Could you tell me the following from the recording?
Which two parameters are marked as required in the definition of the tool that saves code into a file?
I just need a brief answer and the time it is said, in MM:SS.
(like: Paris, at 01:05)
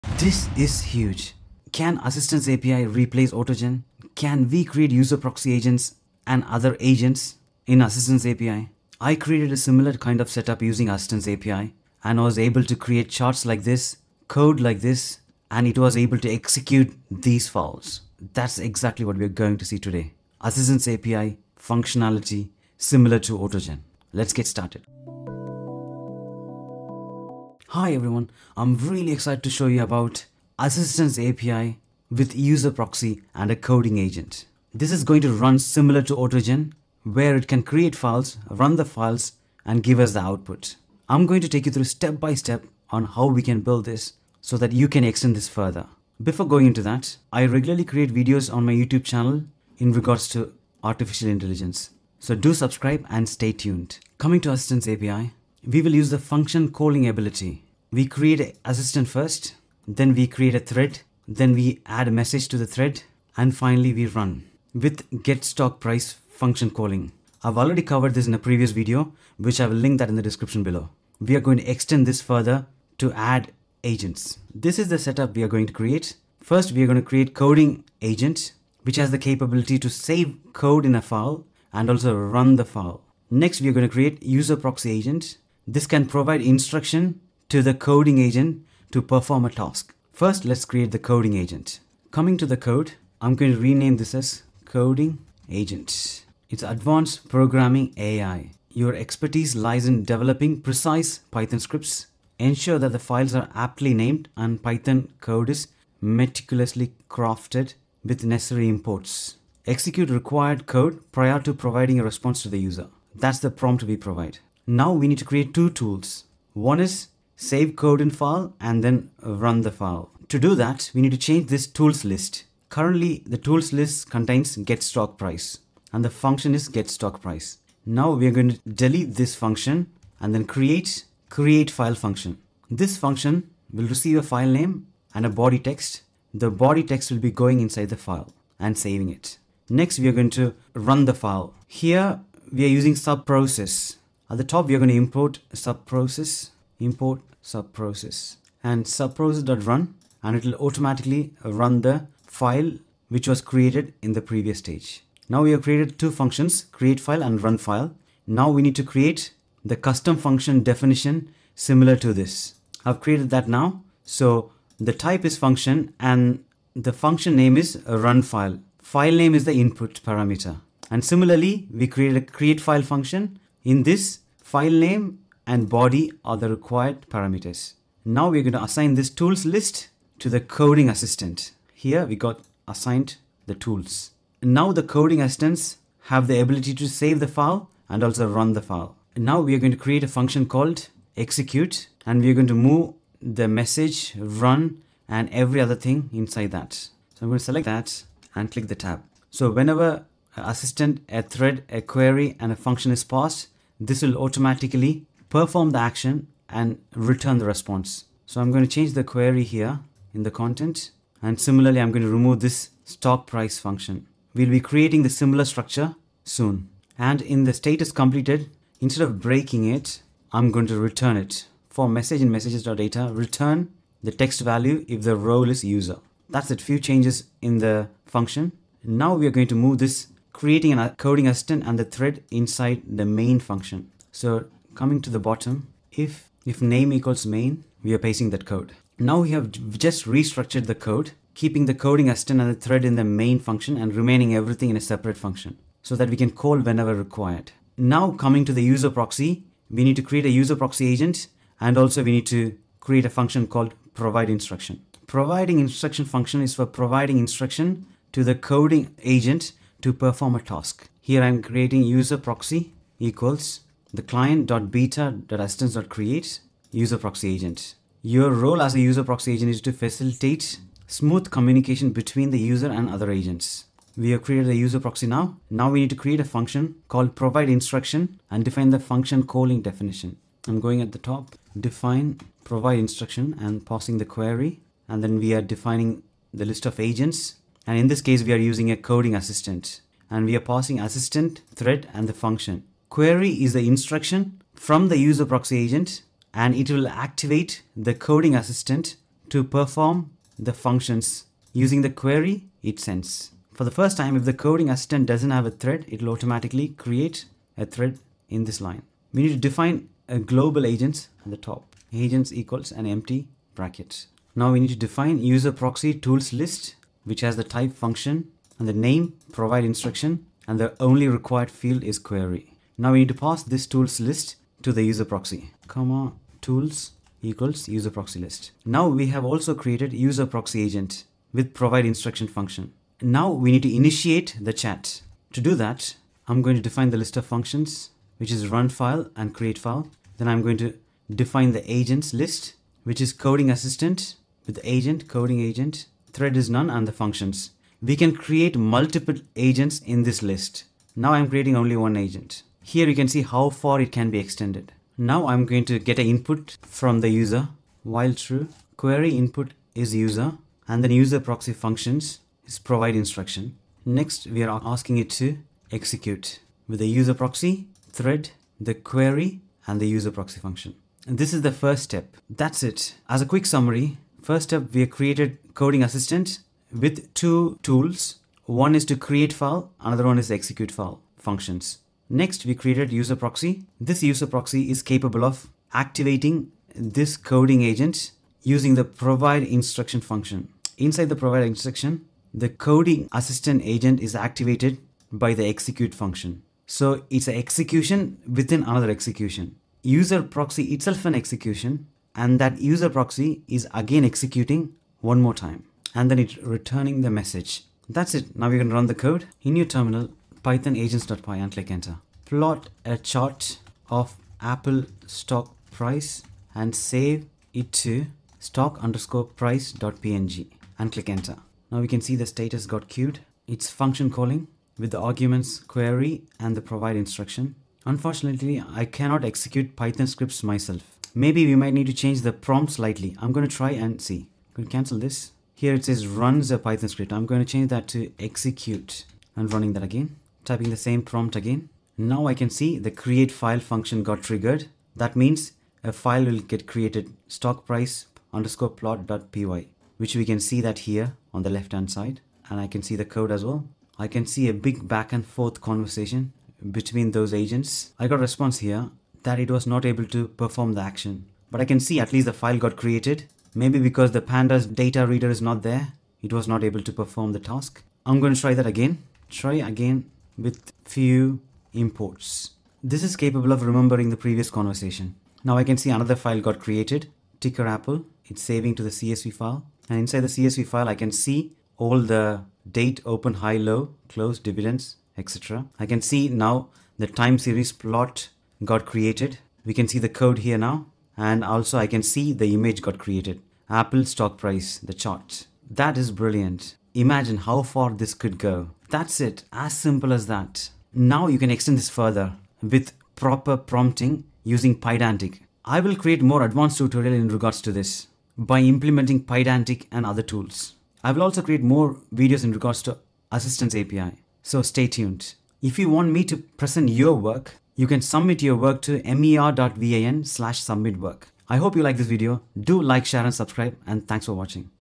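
File name and body, at 02:54.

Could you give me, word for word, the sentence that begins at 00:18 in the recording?
That's exactly what we're going to see today.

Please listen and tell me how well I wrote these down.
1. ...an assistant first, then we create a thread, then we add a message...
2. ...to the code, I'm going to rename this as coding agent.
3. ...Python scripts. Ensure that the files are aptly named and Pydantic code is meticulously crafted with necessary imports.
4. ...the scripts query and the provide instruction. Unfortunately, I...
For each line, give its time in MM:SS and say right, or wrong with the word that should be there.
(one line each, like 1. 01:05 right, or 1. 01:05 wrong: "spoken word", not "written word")
1. 00:58 right
2. 01:32 right
3. 01:41 wrong: "Python", not "Pydantic"
4. 07:04 wrong: "arguments", not "scripts".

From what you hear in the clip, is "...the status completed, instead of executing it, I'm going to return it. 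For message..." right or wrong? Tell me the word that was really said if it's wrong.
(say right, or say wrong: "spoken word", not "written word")
wrong: "breaking", not "executing".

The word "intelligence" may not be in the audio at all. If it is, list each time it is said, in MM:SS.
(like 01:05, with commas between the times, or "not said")
00:51.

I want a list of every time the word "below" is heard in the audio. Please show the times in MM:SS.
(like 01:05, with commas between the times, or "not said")
01:10.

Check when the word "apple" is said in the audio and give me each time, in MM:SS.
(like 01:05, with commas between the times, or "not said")
06:54, 07:57, 08:13.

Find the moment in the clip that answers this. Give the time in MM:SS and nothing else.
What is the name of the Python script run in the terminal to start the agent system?
06:50.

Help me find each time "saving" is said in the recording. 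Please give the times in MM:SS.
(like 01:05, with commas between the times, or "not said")
02:18, 07:58.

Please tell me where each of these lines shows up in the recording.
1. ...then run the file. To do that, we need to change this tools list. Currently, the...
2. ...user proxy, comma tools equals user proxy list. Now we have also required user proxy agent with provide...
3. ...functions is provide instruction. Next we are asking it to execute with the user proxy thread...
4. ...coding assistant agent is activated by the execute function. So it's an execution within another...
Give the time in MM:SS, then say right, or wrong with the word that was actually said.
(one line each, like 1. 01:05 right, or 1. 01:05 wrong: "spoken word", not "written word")
1. 01:58 right
2. 05:24 wrong: "created", not "required"
3. 06:01 right
4. 06:32 right.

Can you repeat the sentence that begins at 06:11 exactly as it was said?
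And this is the first step.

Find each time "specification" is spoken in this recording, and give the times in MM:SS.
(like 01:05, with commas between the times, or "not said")
not said.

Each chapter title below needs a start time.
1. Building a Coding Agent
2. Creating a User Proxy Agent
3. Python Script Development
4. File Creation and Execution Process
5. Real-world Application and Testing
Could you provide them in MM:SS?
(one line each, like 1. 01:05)
1. 00:30
2. 01:00
3. 01:30
4. 02:00
5. 06:00.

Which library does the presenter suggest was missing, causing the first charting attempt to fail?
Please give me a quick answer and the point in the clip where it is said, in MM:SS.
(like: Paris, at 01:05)
pandas data reader, at 07:44.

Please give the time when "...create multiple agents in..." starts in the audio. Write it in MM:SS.
05:48.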